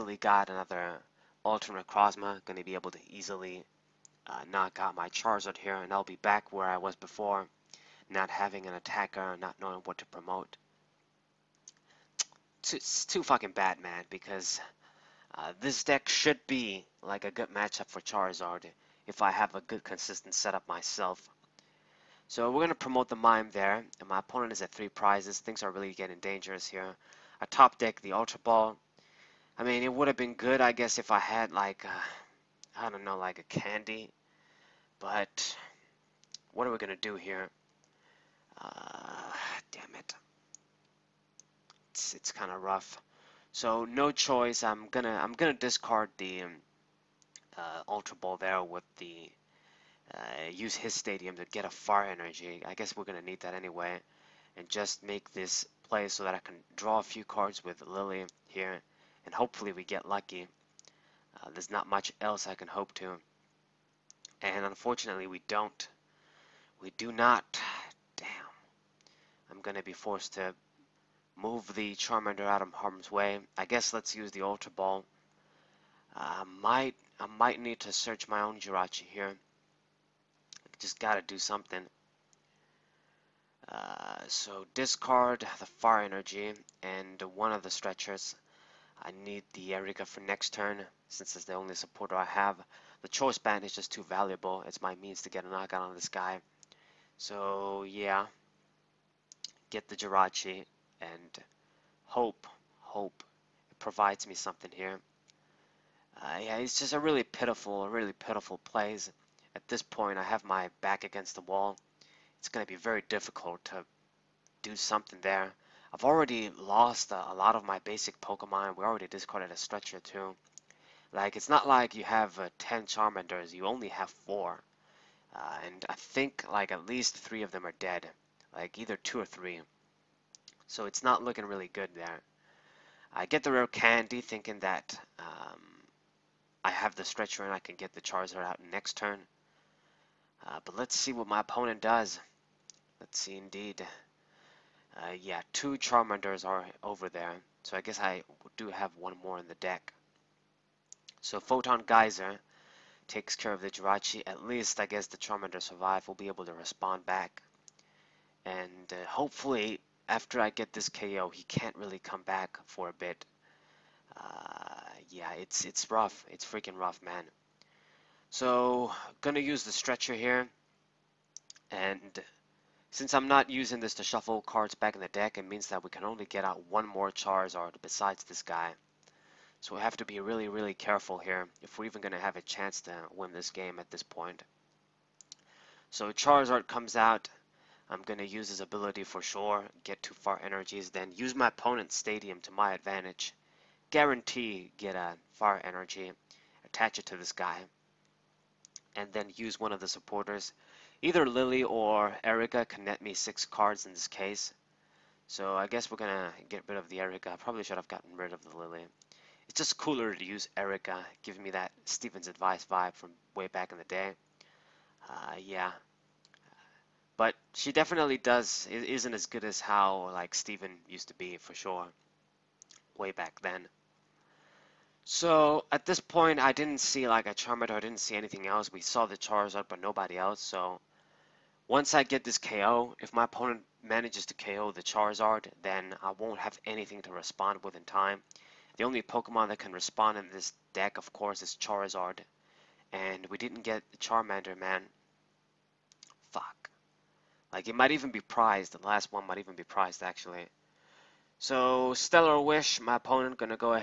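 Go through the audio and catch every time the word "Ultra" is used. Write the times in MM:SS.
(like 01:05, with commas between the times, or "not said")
00:01, 00:28, 00:47, 01:14.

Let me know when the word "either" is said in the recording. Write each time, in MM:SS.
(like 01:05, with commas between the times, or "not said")
02:08, 03:21.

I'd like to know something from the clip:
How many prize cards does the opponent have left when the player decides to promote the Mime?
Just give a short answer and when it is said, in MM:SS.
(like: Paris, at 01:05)
3, at 00:24.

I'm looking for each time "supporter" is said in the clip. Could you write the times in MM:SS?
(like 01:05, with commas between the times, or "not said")
01:31, 03:19.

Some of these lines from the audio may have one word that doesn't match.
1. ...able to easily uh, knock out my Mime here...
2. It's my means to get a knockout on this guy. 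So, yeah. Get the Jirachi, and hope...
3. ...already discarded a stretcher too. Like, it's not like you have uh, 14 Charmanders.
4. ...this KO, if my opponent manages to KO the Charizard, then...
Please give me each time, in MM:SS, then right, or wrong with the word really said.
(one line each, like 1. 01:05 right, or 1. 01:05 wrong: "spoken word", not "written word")
1. 00:02 wrong: "Charizard", not "Mime"
2. 01:34 right
3. 01:58 wrong: "10", not "14"
4. 03:52 right.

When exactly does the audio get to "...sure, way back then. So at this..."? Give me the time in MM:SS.
03:41.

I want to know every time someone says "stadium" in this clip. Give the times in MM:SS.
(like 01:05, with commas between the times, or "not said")
00:50, 03:11.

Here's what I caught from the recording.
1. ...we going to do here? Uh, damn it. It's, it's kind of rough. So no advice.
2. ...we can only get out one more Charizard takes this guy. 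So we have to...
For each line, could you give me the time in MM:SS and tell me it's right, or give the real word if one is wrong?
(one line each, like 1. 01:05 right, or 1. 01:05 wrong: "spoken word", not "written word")
1. 00:36 wrong: "choice", not "advice"
2. 02:55 wrong: "besides", not "takes".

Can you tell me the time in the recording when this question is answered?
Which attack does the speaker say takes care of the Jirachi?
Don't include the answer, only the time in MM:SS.
02:31.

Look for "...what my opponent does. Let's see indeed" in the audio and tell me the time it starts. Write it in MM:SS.
02:21.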